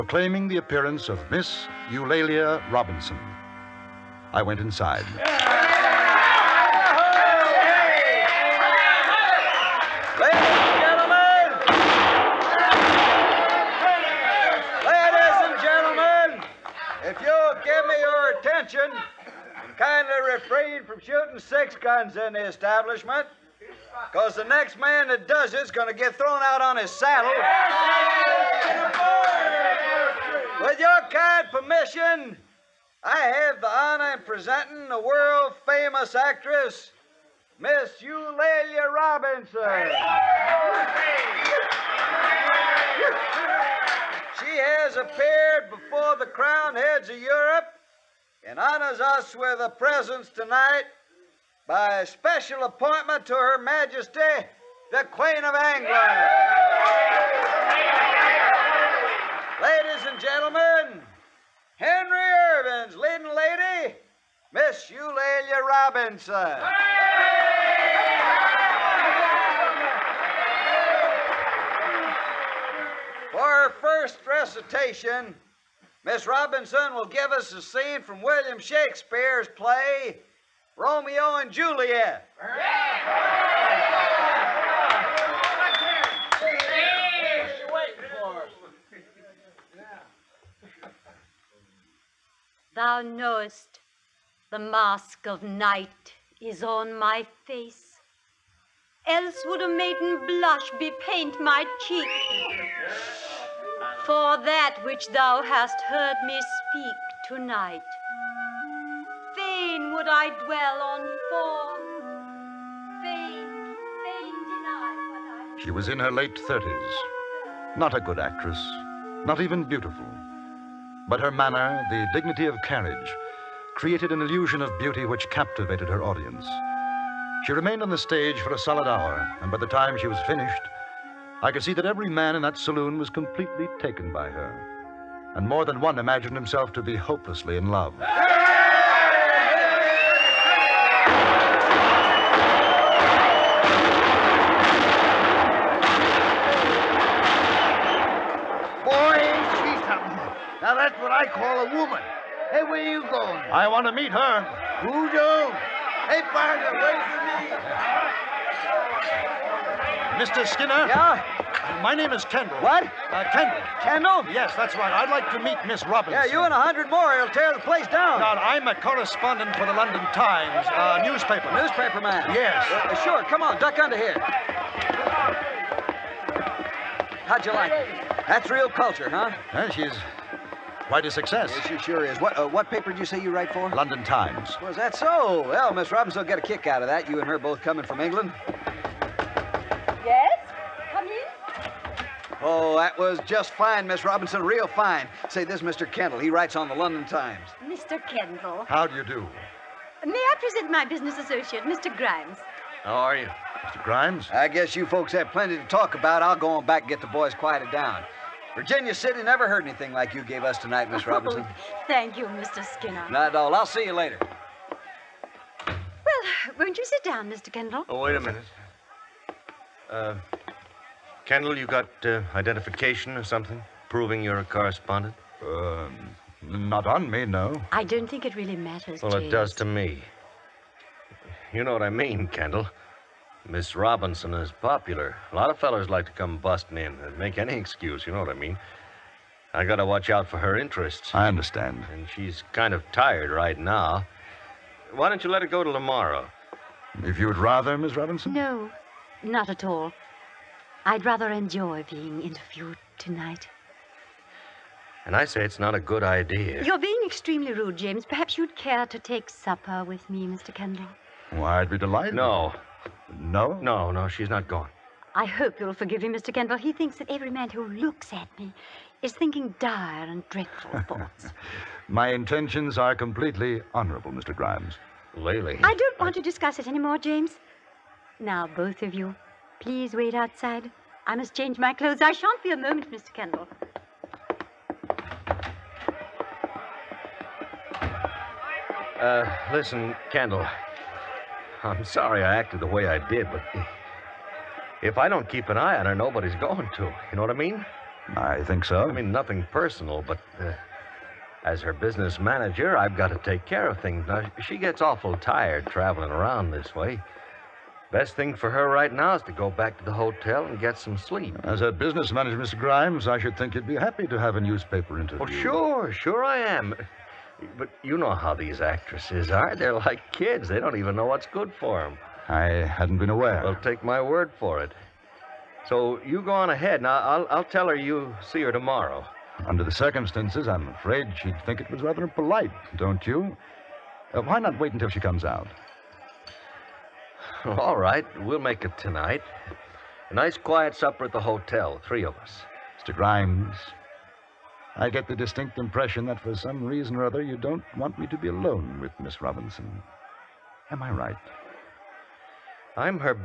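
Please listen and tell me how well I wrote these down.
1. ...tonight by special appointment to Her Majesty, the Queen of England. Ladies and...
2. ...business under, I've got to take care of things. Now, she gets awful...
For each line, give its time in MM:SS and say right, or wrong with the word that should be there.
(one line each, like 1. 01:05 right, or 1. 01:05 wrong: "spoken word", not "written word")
1. 00:50 right
2. 05:01 wrong: "manager", not "under".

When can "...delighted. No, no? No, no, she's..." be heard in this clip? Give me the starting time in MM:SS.
04:21.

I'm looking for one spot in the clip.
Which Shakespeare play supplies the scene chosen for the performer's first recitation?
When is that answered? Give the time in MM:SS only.
01:20.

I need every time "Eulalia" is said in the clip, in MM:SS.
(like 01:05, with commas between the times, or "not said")
00:01, 00:38, 01:04.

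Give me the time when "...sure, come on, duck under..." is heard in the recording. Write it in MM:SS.
02:53.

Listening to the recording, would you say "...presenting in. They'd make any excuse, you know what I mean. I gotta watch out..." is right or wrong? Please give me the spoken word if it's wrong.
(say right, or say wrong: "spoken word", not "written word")
wrong: "busting", not "presenting".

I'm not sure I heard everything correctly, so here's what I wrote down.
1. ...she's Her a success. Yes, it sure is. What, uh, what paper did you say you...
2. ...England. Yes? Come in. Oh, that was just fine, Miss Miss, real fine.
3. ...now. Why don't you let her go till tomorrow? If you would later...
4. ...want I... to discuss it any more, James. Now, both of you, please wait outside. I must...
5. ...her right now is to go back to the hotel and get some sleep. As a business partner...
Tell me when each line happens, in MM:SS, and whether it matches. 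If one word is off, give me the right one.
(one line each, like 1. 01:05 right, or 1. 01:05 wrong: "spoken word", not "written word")
1. 02:59 wrong: "Quite", not "Her"
2. 03:08 wrong: "Robinson", not "Miss"
3. 04:03 wrong: "rather", not "later"
4. 04:35 right
5. 05:08 wrong: "manager", not "partner".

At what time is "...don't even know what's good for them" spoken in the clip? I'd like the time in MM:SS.
05:20.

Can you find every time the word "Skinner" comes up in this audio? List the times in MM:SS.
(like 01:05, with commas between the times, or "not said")
02:40, 03:32.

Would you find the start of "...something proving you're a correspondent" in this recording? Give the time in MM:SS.
03:43.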